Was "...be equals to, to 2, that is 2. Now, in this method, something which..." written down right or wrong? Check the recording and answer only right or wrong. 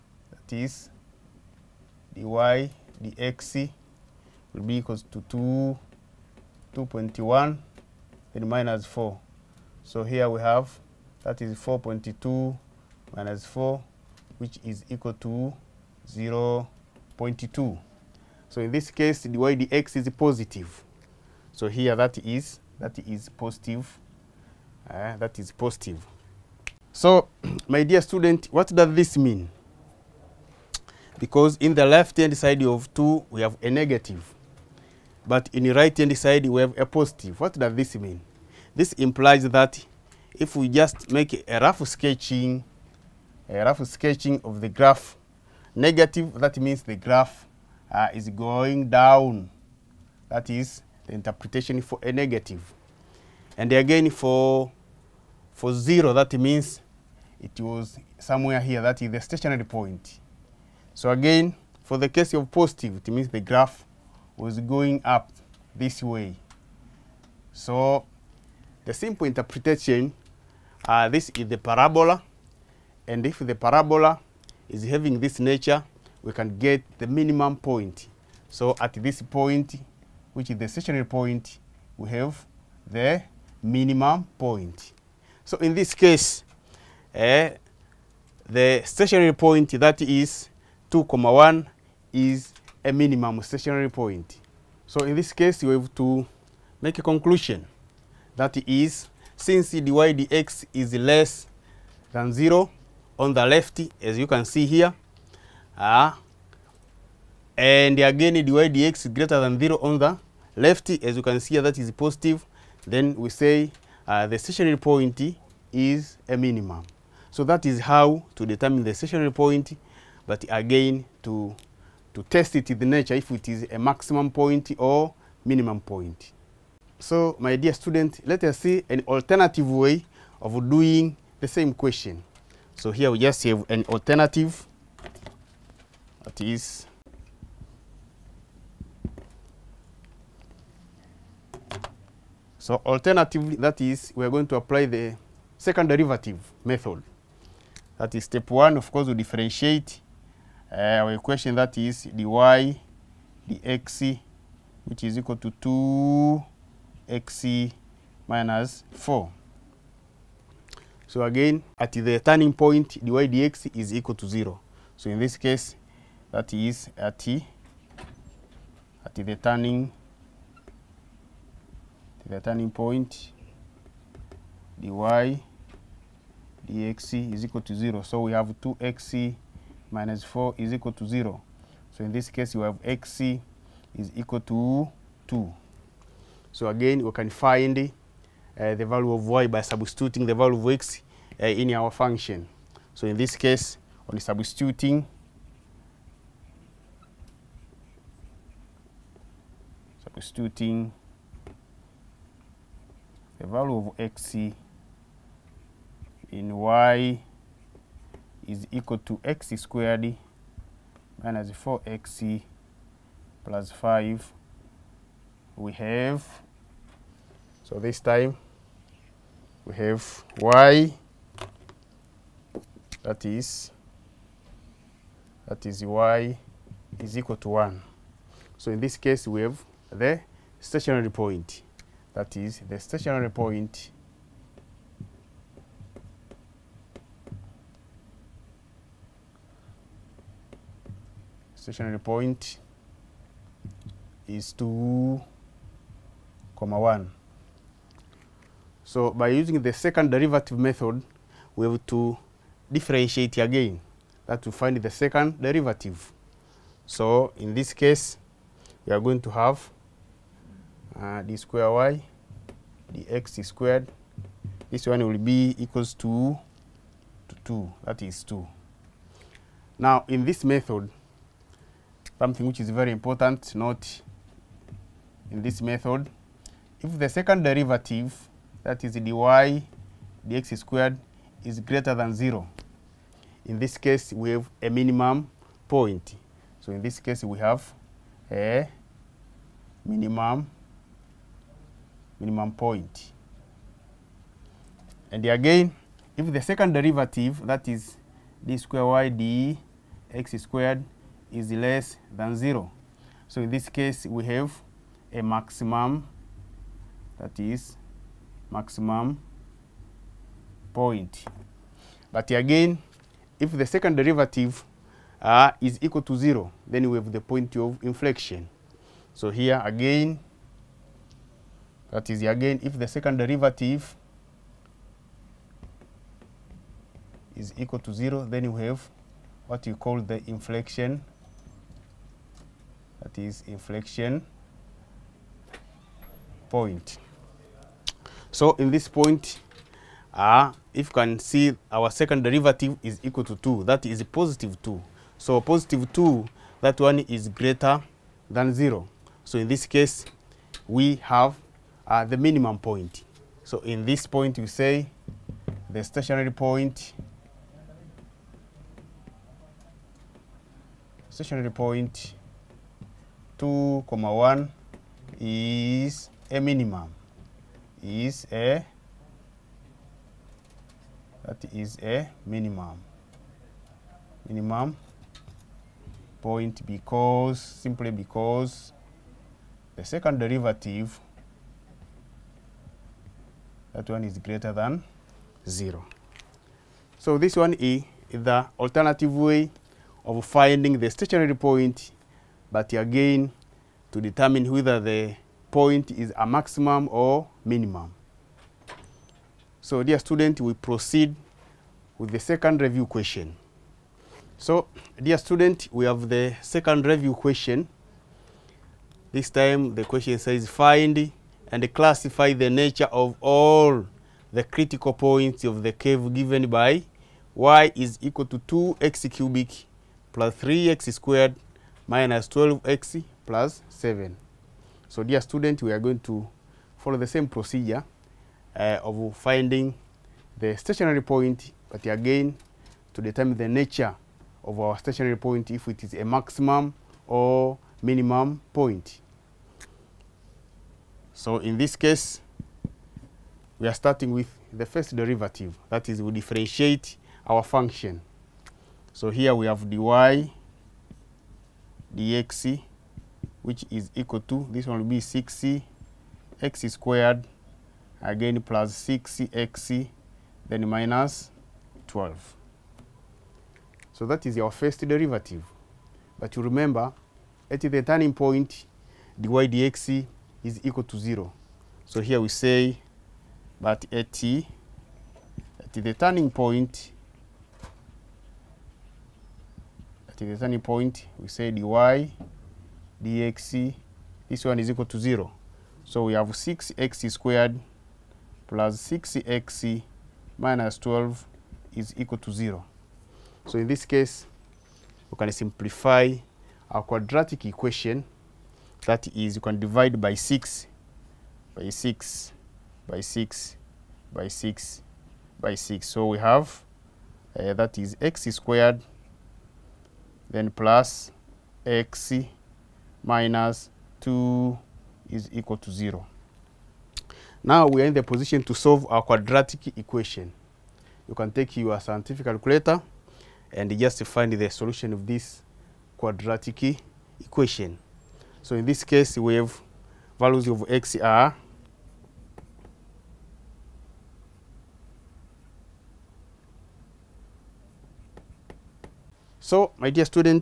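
right.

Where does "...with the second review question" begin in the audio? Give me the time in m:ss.
6:41.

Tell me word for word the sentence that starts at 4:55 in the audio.
And again, if the second derivative, that is d square y d x squared, is less than zero.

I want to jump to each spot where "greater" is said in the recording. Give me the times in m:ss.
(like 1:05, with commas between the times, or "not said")
1:49, 4:41, 5:47, 6:24.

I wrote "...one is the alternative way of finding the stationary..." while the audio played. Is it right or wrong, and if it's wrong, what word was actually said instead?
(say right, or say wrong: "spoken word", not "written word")
right.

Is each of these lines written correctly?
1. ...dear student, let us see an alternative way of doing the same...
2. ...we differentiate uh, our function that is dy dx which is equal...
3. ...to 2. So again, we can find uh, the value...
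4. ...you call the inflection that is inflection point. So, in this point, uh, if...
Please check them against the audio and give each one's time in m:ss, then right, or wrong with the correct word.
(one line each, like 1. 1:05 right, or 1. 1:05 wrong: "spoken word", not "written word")
1. 2:07 right
2. 2:29 wrong: "equation", not "function"
3. 3:04 right
4. 5:29 right.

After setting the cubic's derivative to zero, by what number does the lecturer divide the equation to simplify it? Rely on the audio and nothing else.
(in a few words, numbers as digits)
6.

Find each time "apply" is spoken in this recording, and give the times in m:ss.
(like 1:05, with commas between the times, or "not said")
2:24.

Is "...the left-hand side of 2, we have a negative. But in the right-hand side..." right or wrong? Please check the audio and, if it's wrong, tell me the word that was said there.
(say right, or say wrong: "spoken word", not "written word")
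right.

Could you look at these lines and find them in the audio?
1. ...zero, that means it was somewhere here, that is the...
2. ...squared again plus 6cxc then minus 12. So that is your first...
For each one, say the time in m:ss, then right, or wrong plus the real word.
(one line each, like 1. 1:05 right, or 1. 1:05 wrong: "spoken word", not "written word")
1. 0:55 right
2. 7:36 right.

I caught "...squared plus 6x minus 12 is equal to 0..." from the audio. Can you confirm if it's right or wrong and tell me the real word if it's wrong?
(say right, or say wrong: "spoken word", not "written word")
right.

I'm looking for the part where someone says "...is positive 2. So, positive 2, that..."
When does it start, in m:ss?
5:43.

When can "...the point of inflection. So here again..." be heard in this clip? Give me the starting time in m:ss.
5:17.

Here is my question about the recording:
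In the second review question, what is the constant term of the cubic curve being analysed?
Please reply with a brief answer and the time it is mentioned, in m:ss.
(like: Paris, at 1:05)
7, at 7:03.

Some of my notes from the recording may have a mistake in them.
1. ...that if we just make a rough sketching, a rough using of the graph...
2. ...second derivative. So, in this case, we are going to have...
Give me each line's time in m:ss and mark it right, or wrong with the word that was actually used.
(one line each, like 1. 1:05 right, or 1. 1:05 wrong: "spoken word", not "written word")
1. 0:39 wrong: "sketching", not "using"
2. 4:14 right.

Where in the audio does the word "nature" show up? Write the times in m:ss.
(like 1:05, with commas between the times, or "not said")
1:15, 2:02, 6:52, 7:13.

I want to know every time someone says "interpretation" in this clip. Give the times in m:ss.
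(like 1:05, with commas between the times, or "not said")
0:51, 1:09.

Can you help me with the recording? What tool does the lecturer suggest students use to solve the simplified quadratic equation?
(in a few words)
scientific calculator.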